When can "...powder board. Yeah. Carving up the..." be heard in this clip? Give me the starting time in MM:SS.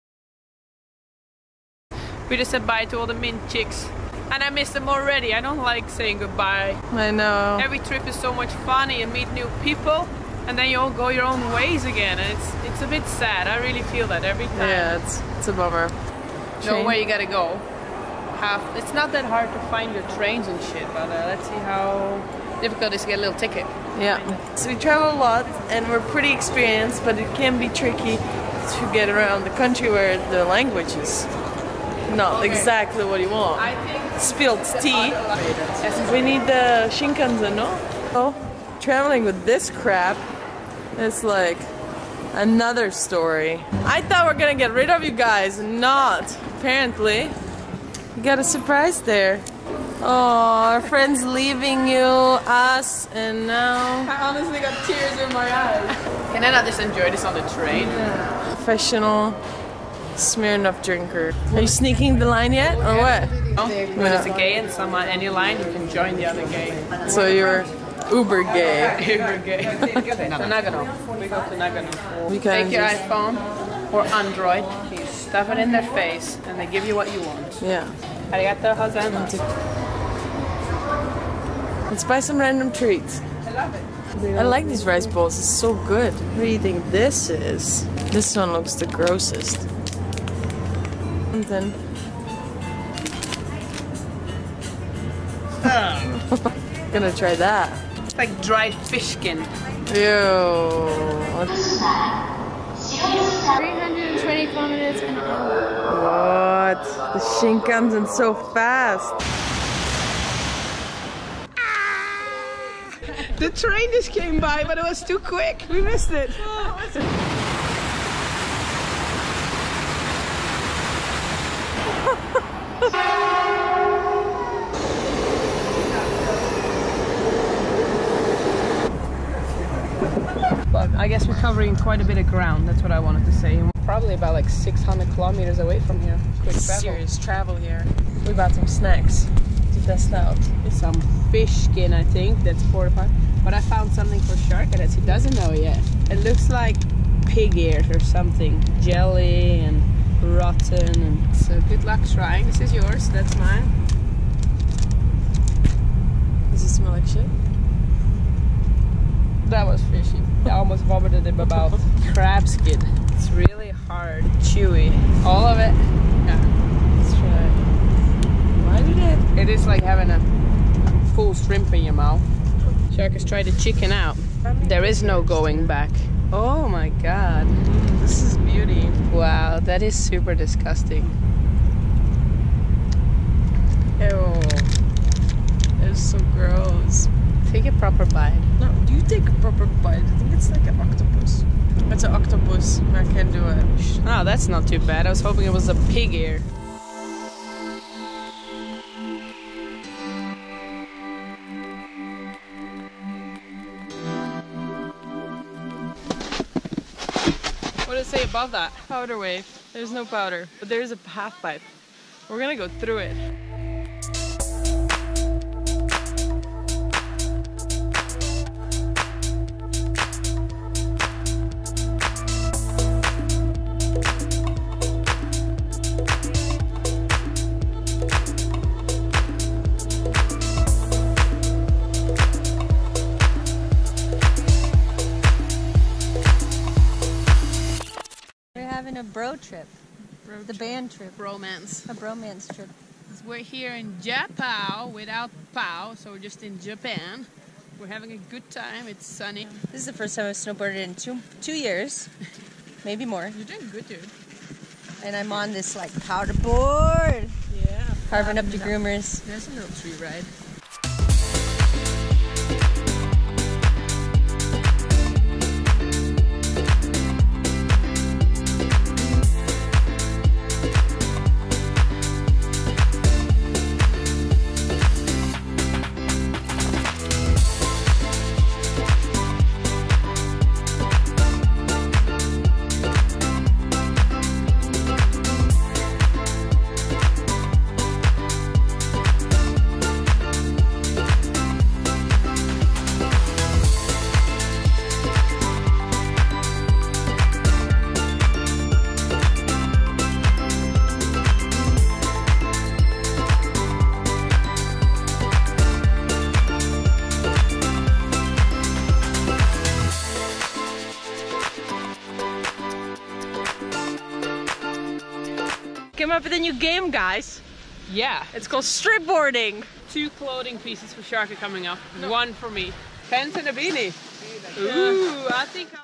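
04:16.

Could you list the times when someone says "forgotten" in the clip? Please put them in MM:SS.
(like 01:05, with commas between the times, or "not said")
not said.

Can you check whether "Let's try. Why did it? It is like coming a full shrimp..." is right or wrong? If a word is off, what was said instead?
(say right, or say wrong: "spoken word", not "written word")
wrong: "having", not "coming".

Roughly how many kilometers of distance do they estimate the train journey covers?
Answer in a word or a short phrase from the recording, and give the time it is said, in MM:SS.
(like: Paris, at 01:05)
600, at 02:14.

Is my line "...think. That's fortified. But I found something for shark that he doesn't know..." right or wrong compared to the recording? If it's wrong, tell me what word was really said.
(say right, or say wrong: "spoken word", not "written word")
right.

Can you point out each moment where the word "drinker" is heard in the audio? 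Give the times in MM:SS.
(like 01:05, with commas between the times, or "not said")
01:00.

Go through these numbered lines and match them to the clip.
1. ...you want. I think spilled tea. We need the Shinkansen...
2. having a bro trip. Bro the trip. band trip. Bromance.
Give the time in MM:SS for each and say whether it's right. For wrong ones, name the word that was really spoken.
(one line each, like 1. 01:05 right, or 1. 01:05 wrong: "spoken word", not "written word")
1. 00:33 right
2. 03:58 right.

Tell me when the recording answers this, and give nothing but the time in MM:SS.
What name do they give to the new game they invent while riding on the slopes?
05:18.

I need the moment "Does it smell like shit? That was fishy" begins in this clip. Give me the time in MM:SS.
02:36.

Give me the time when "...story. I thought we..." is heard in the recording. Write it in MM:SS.
00:42.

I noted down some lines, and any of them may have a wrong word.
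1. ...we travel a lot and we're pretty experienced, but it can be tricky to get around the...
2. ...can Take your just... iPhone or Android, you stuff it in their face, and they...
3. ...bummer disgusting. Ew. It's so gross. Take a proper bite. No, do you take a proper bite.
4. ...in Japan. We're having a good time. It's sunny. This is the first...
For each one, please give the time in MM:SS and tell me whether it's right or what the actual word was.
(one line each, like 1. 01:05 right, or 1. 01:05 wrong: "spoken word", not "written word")
1. 00:24 right
2. 01:12 right
3. 02:59 wrong: "super", not "bummer"
4. 04:06 right.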